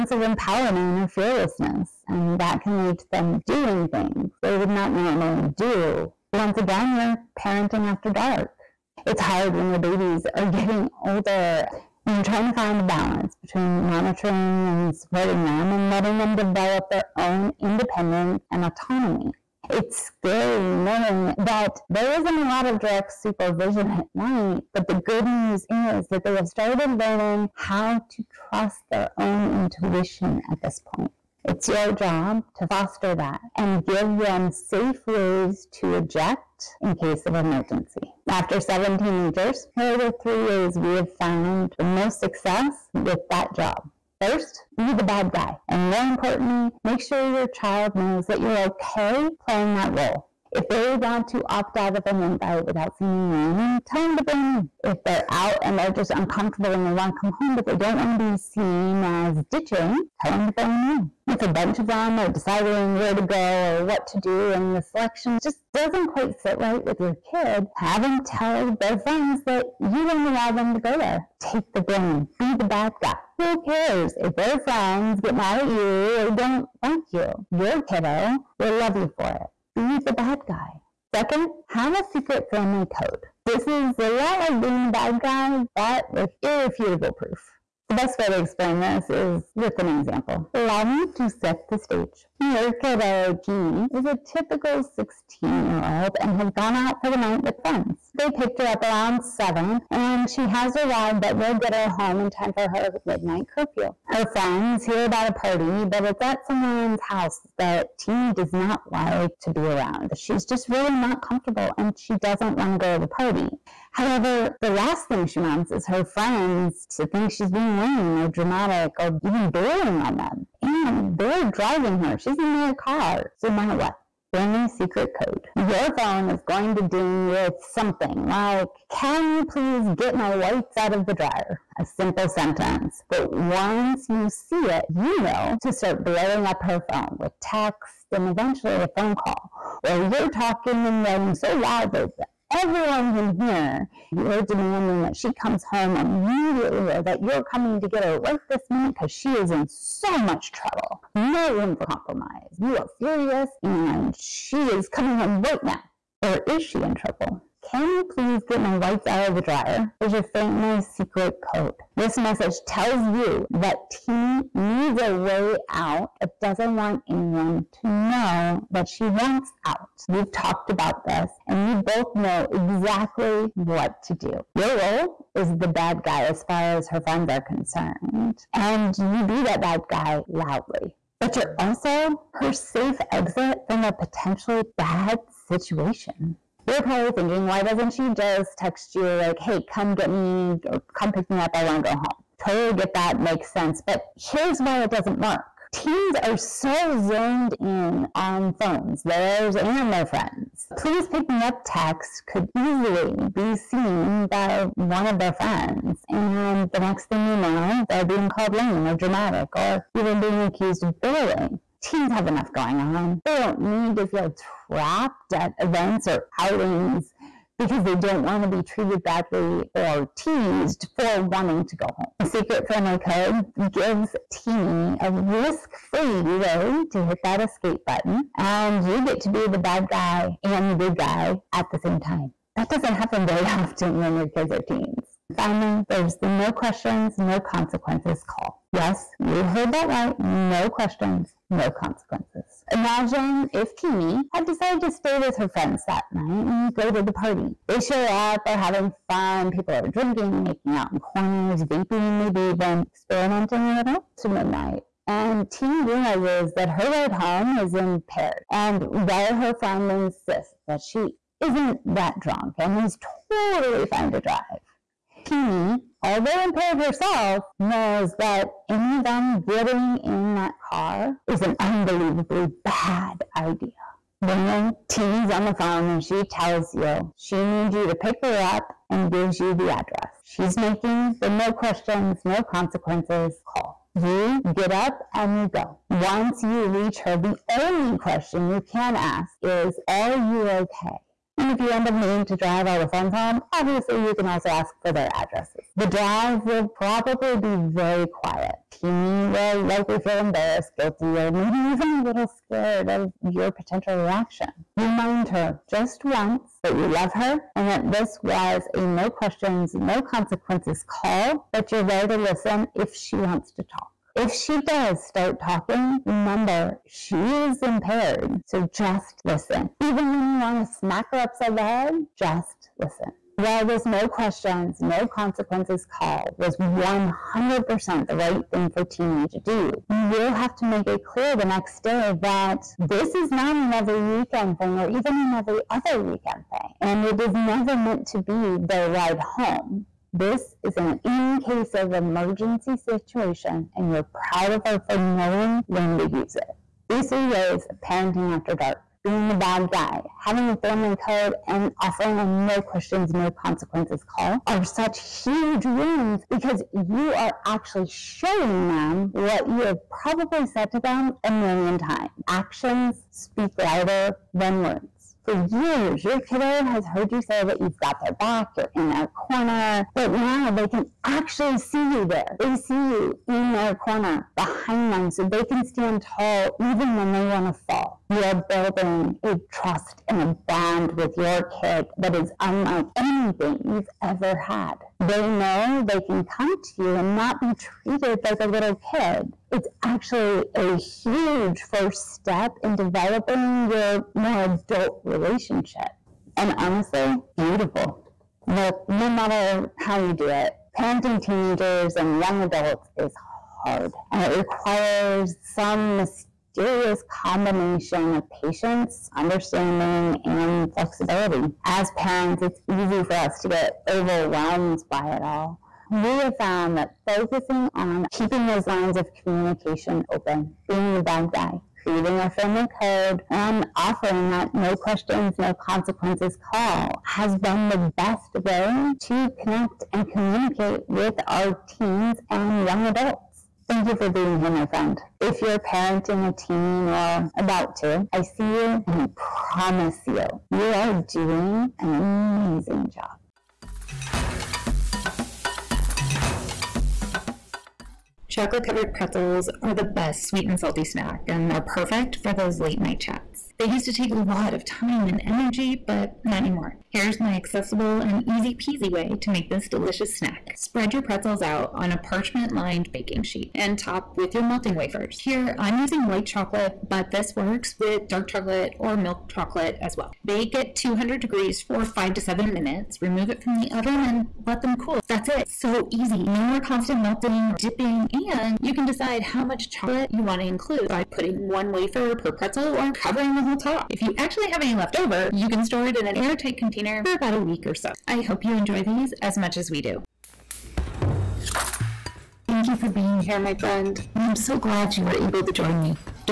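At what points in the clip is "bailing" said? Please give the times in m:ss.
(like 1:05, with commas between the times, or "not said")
1:59, 3:31.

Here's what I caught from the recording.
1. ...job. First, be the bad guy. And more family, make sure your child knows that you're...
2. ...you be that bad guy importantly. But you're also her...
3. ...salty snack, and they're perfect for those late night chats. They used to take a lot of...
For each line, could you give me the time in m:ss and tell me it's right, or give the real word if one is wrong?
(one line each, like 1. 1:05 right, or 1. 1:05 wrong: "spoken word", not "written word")
1. 0:43 wrong: "importantly", not "family"
2. 2:58 wrong: "loudly", not "importantly"
3. 7:30 right.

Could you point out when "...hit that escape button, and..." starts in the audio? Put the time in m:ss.
3:47.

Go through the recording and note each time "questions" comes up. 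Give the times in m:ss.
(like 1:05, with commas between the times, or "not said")
3:56, 4:00, 4:41, 4:47, 5:09, 5:24, 5:52, 7:04.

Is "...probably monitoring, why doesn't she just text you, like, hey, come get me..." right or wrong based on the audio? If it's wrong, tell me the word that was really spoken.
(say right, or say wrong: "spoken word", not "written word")
wrong: "thinking", not "monitoring".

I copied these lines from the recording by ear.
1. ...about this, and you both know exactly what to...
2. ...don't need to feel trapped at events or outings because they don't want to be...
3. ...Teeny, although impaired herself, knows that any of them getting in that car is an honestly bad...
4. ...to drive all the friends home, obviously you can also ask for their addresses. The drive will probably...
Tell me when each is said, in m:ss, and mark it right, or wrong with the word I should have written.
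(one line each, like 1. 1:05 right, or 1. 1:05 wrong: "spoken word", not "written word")
1. 2:50 right
2. 3:33 right
3. 4:25 wrong: "unbelievably", not "honestly"
4. 4:52 right.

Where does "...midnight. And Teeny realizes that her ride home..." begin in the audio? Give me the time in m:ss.
4:14.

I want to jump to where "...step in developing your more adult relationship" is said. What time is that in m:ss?
6:32.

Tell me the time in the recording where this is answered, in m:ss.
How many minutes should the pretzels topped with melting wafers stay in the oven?
7:51.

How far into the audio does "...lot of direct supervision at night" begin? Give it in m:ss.
0:22.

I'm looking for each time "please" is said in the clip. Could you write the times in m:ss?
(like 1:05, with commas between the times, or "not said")
2:09, 2:38, 3:20.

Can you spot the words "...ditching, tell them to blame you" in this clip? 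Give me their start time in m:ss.
0:59.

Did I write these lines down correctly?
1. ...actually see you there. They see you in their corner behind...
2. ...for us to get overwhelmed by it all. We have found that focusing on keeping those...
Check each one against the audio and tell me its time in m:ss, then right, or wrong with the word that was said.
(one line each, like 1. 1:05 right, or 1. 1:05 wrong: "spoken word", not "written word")
1. 6:11 right
2. 6:53 right.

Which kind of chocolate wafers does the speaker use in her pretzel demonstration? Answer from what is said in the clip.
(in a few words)
White chocolate.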